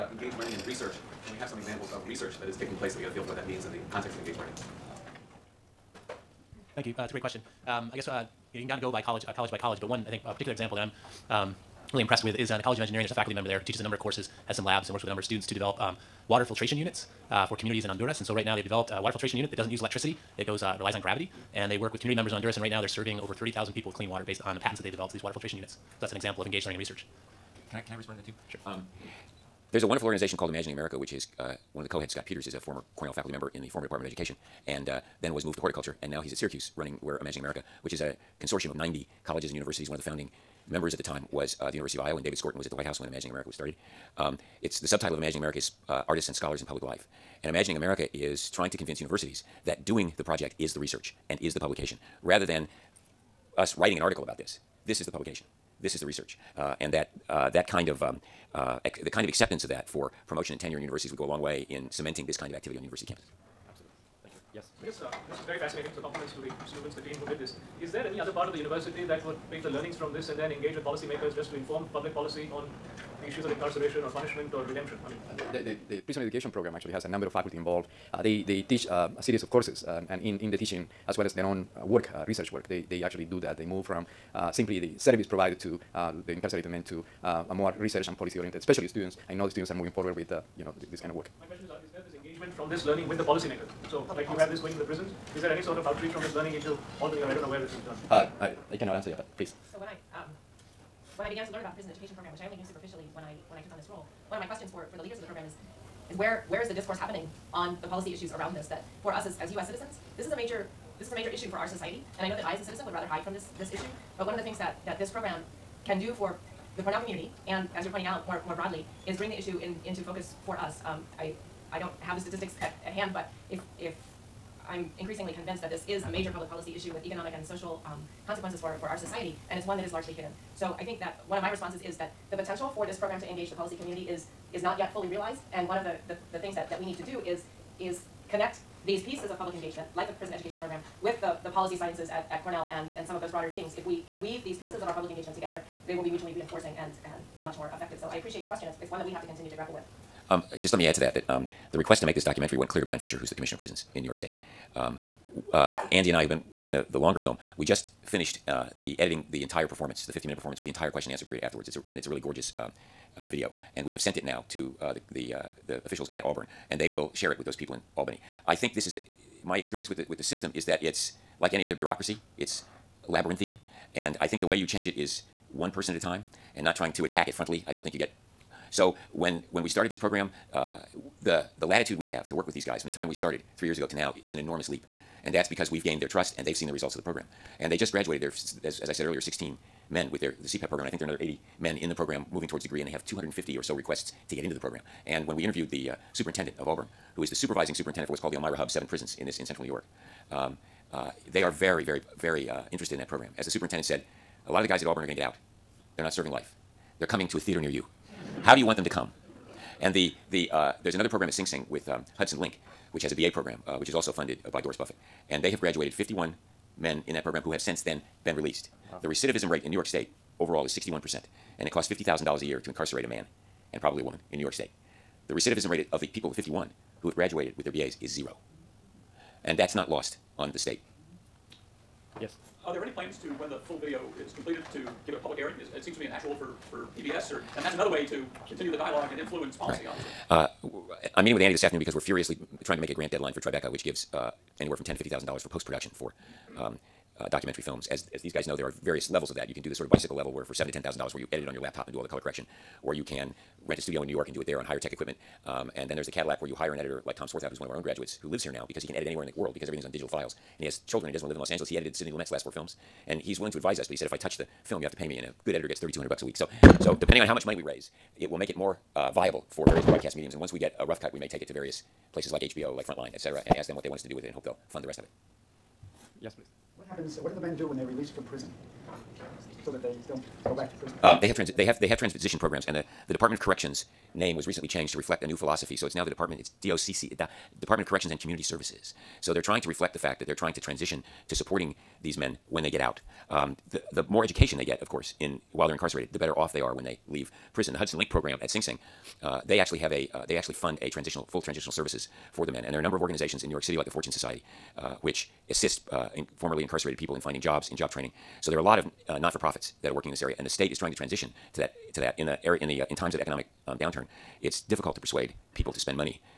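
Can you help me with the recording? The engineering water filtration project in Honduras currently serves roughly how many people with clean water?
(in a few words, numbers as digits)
over 30,000.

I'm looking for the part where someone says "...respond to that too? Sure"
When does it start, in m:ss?
0:27.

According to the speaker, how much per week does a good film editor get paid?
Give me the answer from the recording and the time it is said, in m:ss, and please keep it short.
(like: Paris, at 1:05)
$3,200, at 4:25.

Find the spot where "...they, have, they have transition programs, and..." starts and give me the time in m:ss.
4:41.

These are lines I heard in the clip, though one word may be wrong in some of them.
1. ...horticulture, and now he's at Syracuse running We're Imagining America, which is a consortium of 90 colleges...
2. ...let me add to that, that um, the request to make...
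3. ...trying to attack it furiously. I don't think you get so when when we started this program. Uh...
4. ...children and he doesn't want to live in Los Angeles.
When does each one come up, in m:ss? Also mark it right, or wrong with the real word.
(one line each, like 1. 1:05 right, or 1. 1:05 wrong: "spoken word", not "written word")
1. 0:35 right
2. 2:30 right
3. 2:56 wrong: "frontally", not "furiously"
4. 4:20 right.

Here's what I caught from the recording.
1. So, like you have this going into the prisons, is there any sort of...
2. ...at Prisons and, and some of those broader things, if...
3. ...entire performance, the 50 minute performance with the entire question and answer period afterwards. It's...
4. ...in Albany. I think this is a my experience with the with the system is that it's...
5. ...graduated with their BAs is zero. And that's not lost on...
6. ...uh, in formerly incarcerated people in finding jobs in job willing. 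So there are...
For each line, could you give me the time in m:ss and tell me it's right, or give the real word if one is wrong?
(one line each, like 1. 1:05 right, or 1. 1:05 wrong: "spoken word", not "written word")
1. 1:33 right
2. 2:22 wrong: "Cornell", not "Prisons"
3. 2:39 right
4. 2:47 right
5. 3:47 right
6. 5:05 wrong: "training", not "willing".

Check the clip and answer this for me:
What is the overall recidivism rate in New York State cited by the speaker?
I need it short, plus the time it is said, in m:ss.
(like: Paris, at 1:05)
61%, at 3:40.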